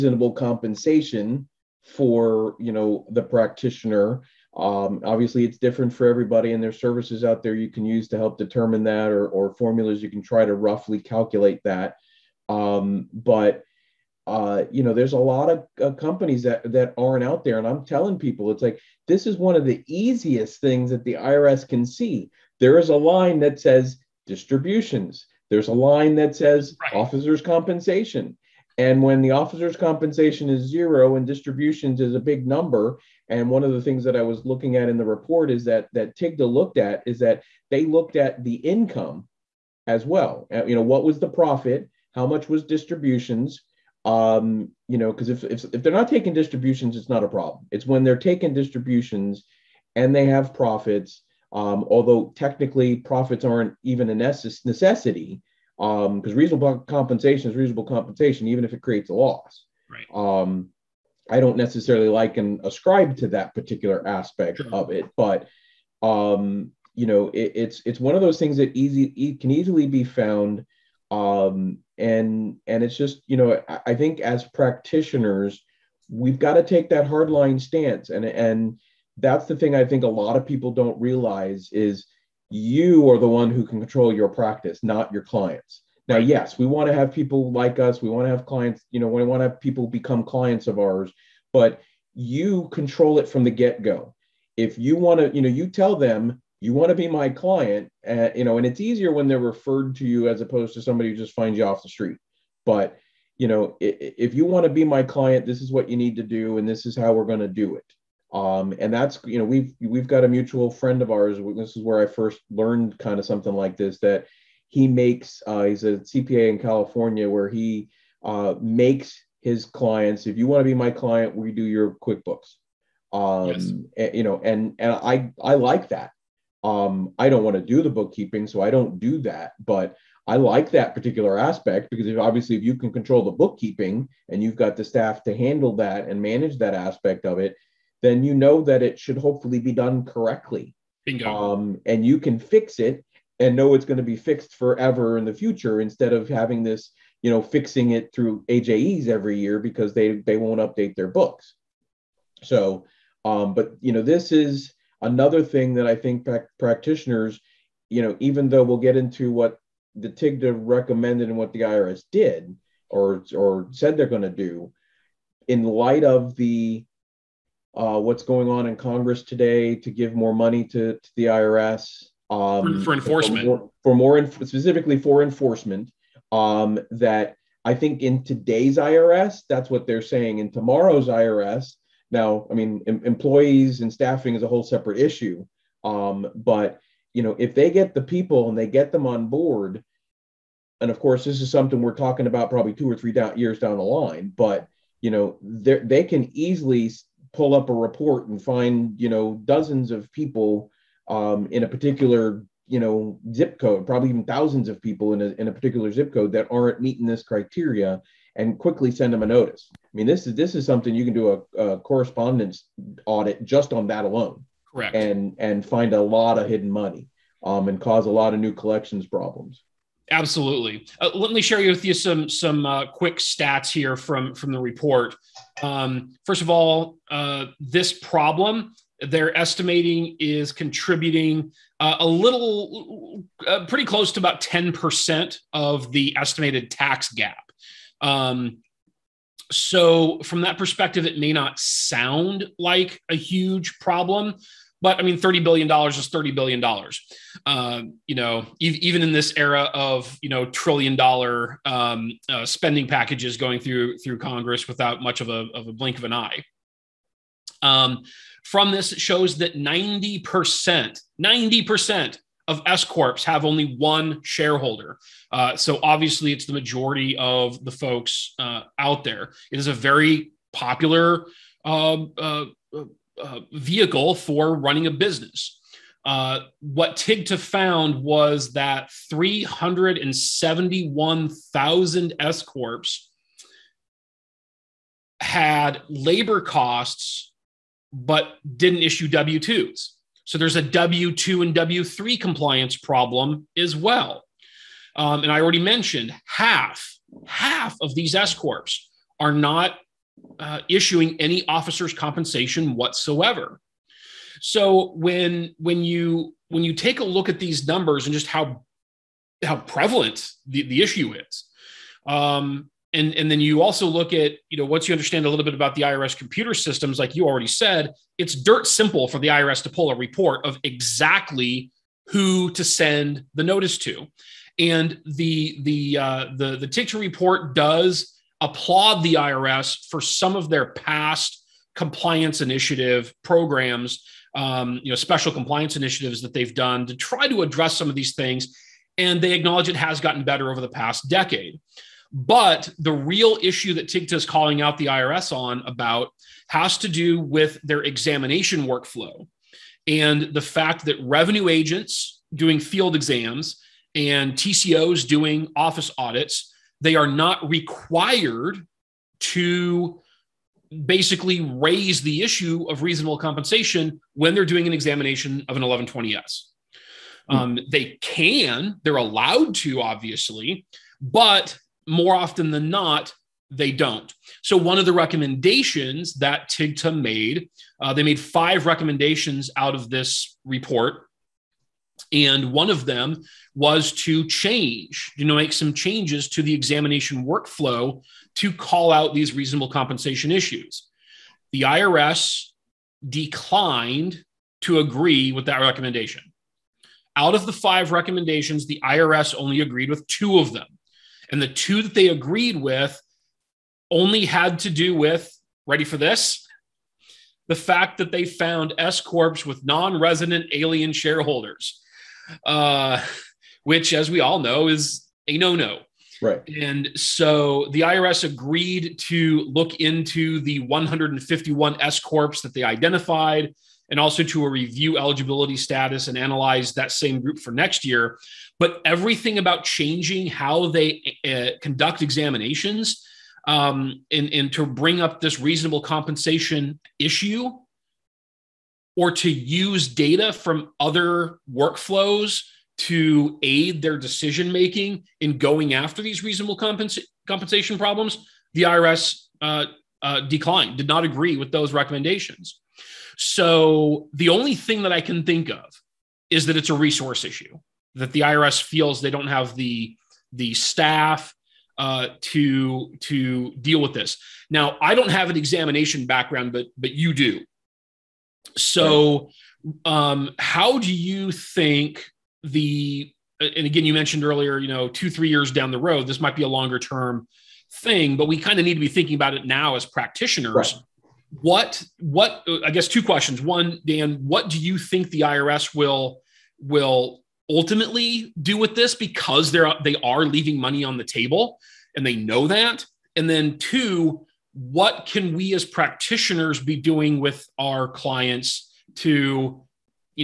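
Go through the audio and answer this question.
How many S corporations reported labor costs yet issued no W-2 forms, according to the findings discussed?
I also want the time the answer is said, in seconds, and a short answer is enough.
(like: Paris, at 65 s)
371,000, at 279 s.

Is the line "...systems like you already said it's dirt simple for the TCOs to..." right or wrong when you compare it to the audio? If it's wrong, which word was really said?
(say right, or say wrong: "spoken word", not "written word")
wrong: "IRS", not "TCOs".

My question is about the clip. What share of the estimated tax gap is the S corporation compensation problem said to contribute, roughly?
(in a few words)
10 percent.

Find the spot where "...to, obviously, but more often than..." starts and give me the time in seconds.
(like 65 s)
369 s.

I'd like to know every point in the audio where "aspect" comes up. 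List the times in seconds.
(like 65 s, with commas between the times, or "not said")
64 s, 131 s, 136 s.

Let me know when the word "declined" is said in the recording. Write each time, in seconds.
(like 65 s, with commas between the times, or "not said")
393 s, 450 s.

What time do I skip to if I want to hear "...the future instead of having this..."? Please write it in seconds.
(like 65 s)
145 s.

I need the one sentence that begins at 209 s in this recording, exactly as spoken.
I mean, this is this is something you can do a, a correspondence audit just on that alone, correct?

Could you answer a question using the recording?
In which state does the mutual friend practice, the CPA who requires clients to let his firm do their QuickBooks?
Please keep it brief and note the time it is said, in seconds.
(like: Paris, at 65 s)
California, at 116 s.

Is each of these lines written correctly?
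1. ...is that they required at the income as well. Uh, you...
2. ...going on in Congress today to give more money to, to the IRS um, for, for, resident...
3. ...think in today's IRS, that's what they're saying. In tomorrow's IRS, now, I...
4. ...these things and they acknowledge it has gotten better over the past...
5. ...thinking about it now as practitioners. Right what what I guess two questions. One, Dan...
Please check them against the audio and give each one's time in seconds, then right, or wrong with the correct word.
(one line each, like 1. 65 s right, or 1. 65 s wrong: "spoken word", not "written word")
1. 37 s wrong: "looked", not "required"
2. 168 s wrong: "enforcement", not "resident"
3. 177 s right
4. 337 s right
5. 478 s right.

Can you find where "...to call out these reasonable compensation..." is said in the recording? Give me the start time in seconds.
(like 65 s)
388 s.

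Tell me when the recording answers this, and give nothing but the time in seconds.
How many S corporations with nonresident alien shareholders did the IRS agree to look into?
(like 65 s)
420 s.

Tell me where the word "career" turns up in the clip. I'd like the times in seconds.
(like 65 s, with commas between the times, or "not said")
not said.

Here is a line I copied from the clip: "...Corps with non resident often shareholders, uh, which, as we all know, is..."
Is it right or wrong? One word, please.
wrong.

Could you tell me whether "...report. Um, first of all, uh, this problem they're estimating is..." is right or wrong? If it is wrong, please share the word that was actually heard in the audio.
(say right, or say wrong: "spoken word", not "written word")
right.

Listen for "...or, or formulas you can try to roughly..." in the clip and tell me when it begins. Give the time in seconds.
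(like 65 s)
9 s.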